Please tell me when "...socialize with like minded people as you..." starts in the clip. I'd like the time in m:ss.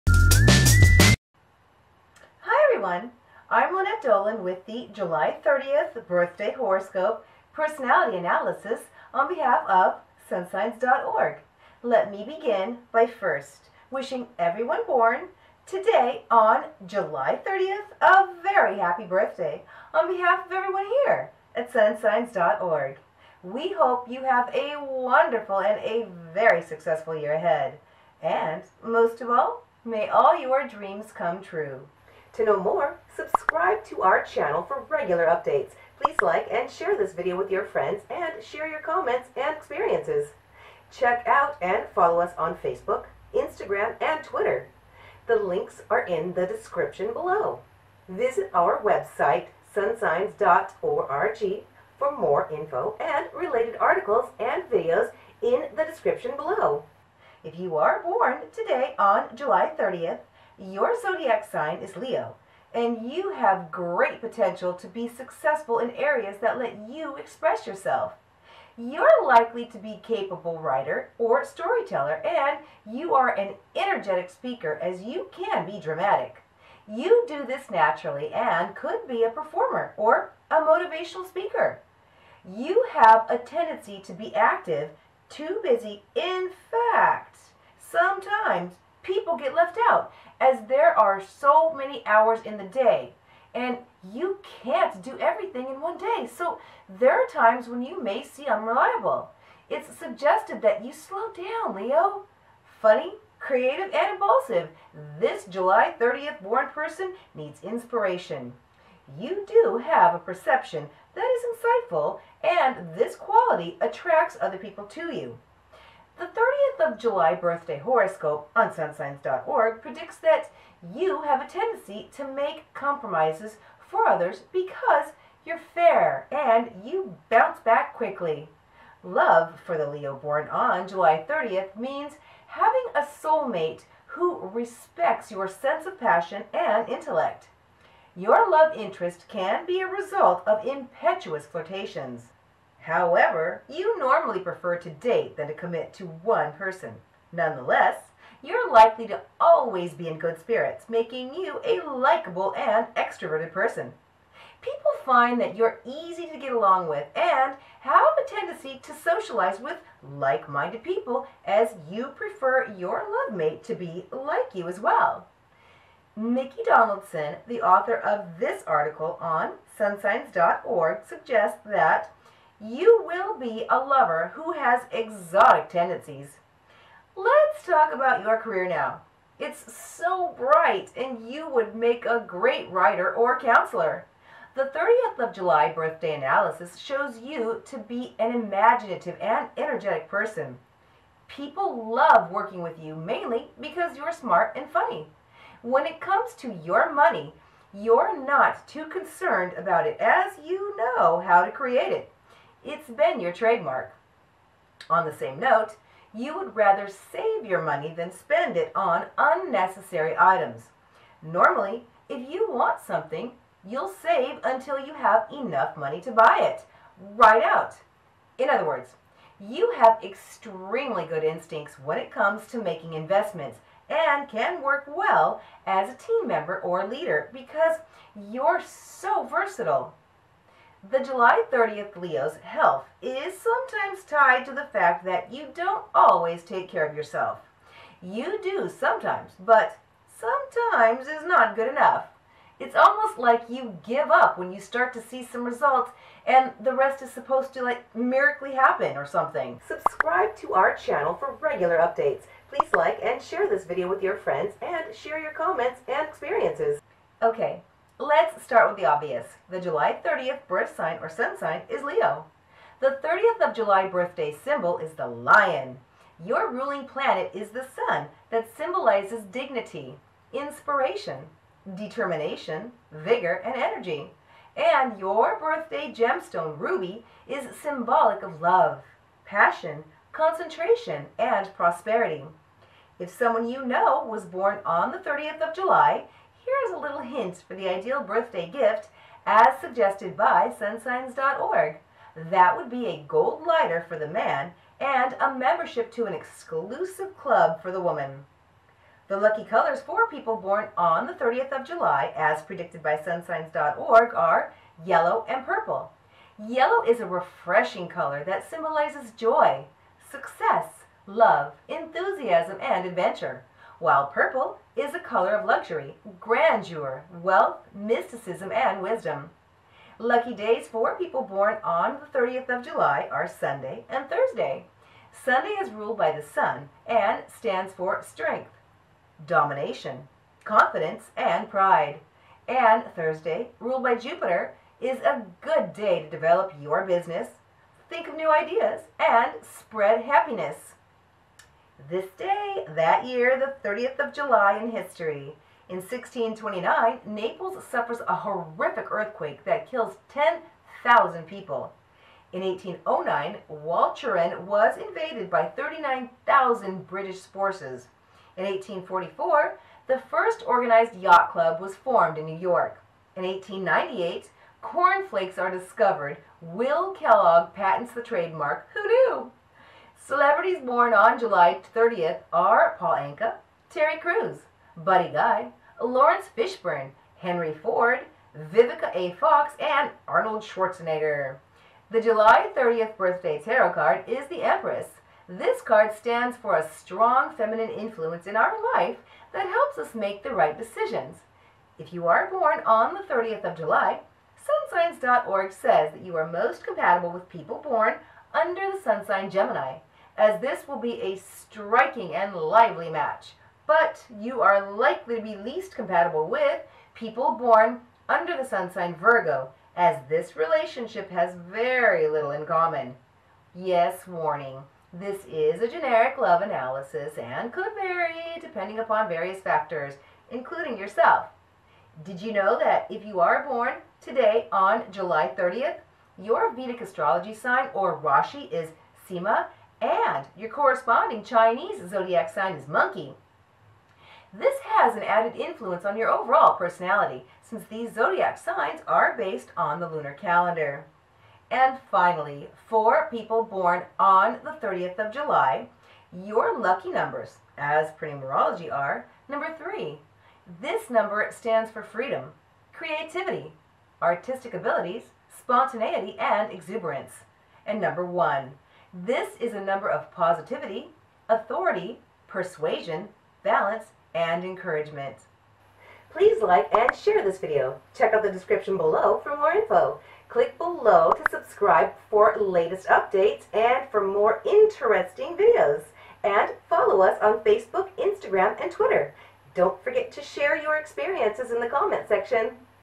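2:38.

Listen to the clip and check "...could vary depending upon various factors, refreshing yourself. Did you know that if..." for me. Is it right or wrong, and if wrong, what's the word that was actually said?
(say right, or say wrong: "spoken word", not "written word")
wrong: "including", not "refreshing".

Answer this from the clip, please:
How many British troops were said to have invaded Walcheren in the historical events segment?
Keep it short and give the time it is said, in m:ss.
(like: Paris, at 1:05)
39,000, at 5:55.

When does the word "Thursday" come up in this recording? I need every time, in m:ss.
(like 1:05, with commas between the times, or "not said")
5:24, 5:32.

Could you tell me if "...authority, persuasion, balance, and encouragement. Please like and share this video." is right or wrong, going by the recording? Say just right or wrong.
right.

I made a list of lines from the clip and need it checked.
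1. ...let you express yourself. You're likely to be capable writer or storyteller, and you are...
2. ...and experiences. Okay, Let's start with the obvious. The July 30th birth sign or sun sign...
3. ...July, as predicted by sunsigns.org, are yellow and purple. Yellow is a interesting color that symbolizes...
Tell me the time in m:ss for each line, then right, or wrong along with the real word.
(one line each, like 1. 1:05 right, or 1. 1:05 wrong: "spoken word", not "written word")
1. 1:06 right
2. 4:15 right
3. 5:01 wrong: "refreshing", not "interesting".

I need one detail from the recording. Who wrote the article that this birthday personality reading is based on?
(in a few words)
Nikki Donaldson.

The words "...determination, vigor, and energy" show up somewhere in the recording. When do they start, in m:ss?
4:31.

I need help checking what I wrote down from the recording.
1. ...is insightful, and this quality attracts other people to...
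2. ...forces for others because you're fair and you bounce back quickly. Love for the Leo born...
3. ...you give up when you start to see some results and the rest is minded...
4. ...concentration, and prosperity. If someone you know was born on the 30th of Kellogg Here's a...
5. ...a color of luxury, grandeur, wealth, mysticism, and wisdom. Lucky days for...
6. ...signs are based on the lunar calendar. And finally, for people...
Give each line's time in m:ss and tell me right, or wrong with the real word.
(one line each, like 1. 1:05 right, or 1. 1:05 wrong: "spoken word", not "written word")
1. 1:51 right
2. 2:02 wrong: "compromises", not "forces"
3. 4:03 wrong: "supposed", not "minded"
4. 4:40 wrong: "July", not "Kellogg"
5. 5:14 right
6. 7:18 right.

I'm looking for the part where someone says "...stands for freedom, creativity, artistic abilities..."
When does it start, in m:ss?
7:31.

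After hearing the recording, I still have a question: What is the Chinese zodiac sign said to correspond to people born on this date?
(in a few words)
Monkey.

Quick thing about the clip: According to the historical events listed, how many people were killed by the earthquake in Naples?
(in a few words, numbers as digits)
10,000.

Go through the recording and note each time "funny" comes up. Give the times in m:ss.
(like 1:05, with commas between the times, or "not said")
1:42, 3:14.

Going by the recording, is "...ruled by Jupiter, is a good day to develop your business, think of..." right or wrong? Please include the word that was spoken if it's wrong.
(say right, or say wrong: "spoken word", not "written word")
right.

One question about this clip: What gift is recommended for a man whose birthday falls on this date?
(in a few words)
A gold lighter.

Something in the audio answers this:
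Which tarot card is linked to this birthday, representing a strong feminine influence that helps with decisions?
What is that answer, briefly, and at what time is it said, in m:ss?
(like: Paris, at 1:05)
The Empress, at 6:24.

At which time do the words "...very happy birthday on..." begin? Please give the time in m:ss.
0:18.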